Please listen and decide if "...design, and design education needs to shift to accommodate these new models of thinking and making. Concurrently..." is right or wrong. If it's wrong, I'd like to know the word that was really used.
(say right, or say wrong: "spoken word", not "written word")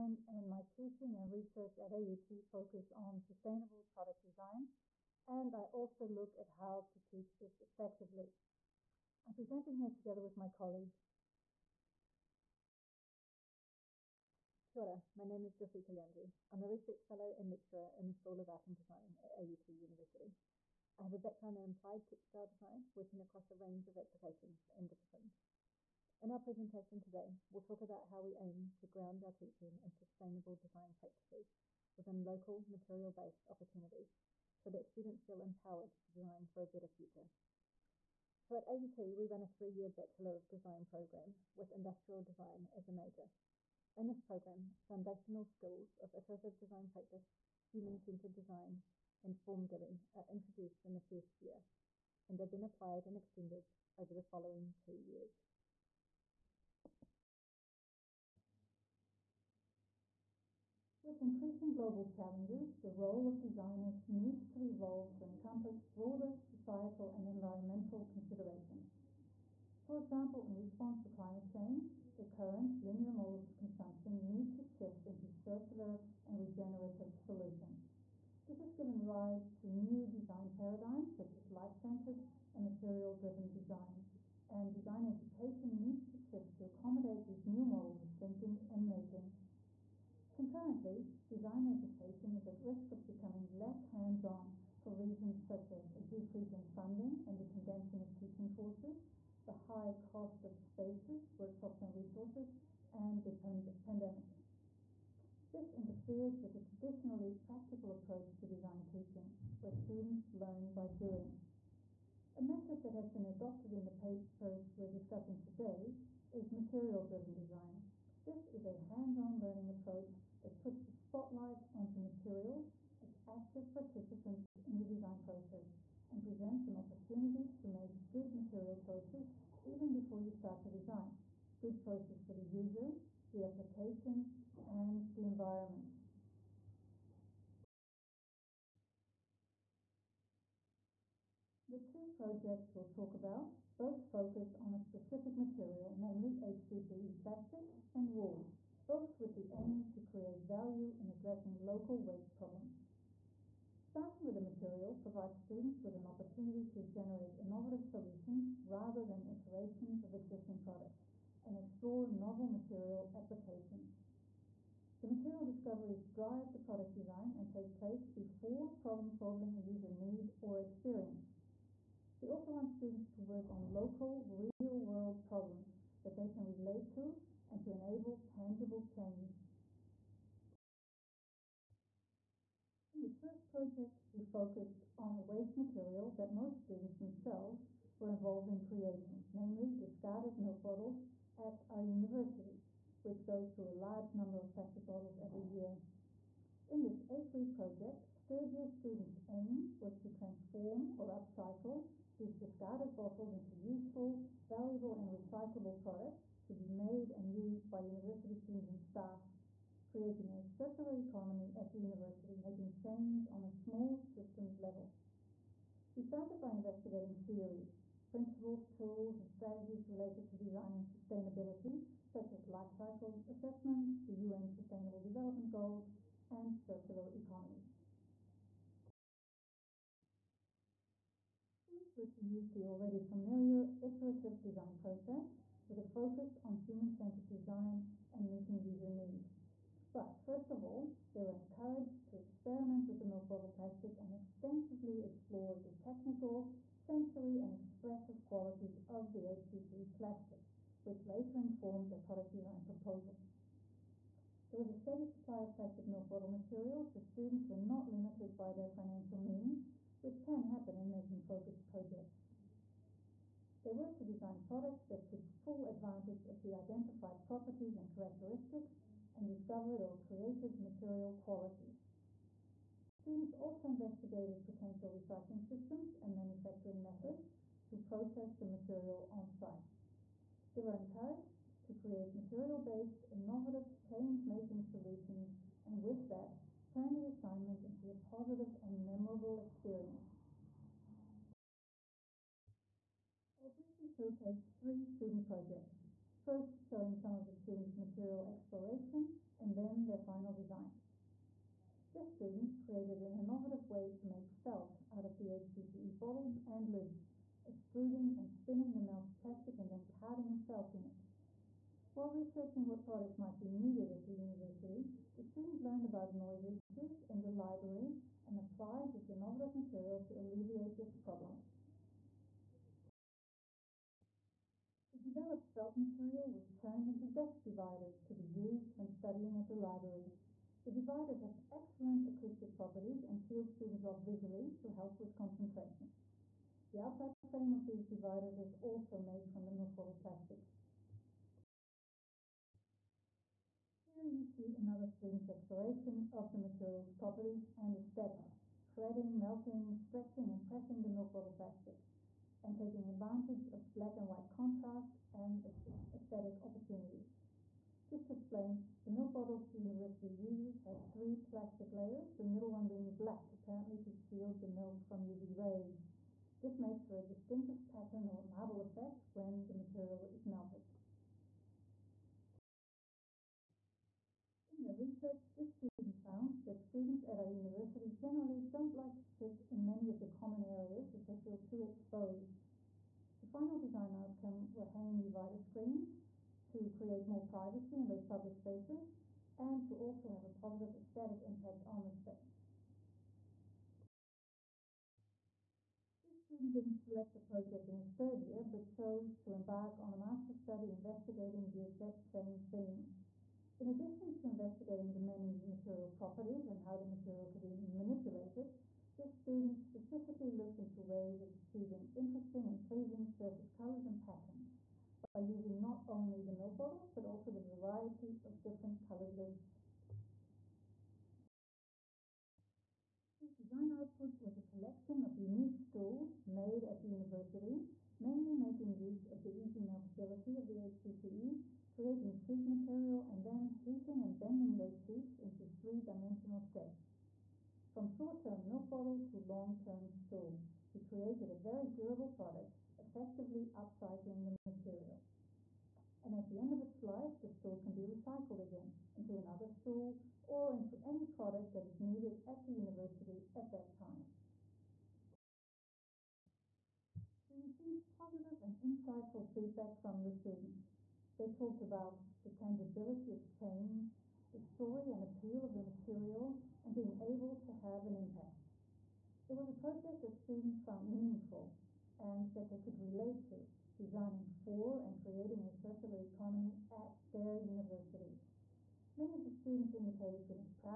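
right.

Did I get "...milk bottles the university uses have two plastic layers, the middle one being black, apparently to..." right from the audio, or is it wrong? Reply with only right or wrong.
wrong.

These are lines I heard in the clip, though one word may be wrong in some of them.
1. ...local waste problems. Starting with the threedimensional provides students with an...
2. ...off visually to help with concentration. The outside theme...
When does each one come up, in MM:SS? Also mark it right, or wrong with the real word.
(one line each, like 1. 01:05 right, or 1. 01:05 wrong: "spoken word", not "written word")
1. 02:31 wrong: "material", not "threedimensional"
2. 05:33 wrong: "frame", not "theme".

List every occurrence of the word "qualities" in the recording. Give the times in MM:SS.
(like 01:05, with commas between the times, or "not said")
04:08, 04:31.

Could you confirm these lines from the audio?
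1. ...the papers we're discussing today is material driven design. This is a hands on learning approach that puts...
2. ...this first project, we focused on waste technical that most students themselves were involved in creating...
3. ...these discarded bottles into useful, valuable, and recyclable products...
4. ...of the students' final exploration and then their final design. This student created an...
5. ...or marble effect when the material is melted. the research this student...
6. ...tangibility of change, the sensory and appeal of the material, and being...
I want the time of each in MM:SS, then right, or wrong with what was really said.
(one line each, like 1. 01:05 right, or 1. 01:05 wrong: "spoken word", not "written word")
1. 01:53 right
2. 03:03 wrong: "material", not "technical"
3. 03:22 right
4. 04:57 wrong: "material", not "final"
5. 06:08 right
6. 07:42 wrong: "story", not "sensory".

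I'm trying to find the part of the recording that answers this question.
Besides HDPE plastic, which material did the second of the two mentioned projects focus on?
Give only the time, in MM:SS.
02:28.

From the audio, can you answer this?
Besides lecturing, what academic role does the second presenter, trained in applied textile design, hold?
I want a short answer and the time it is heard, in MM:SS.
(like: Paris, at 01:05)
Research fellow, at 00:16.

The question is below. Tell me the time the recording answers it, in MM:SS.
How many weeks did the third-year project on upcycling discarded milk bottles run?
03:17.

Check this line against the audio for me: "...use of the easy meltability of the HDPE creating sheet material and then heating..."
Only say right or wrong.
right.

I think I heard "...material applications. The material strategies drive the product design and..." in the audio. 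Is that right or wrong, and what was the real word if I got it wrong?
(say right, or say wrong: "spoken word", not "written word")
wrong: "discoveries", not "strategies".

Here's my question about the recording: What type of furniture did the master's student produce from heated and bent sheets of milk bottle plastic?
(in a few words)
Stools.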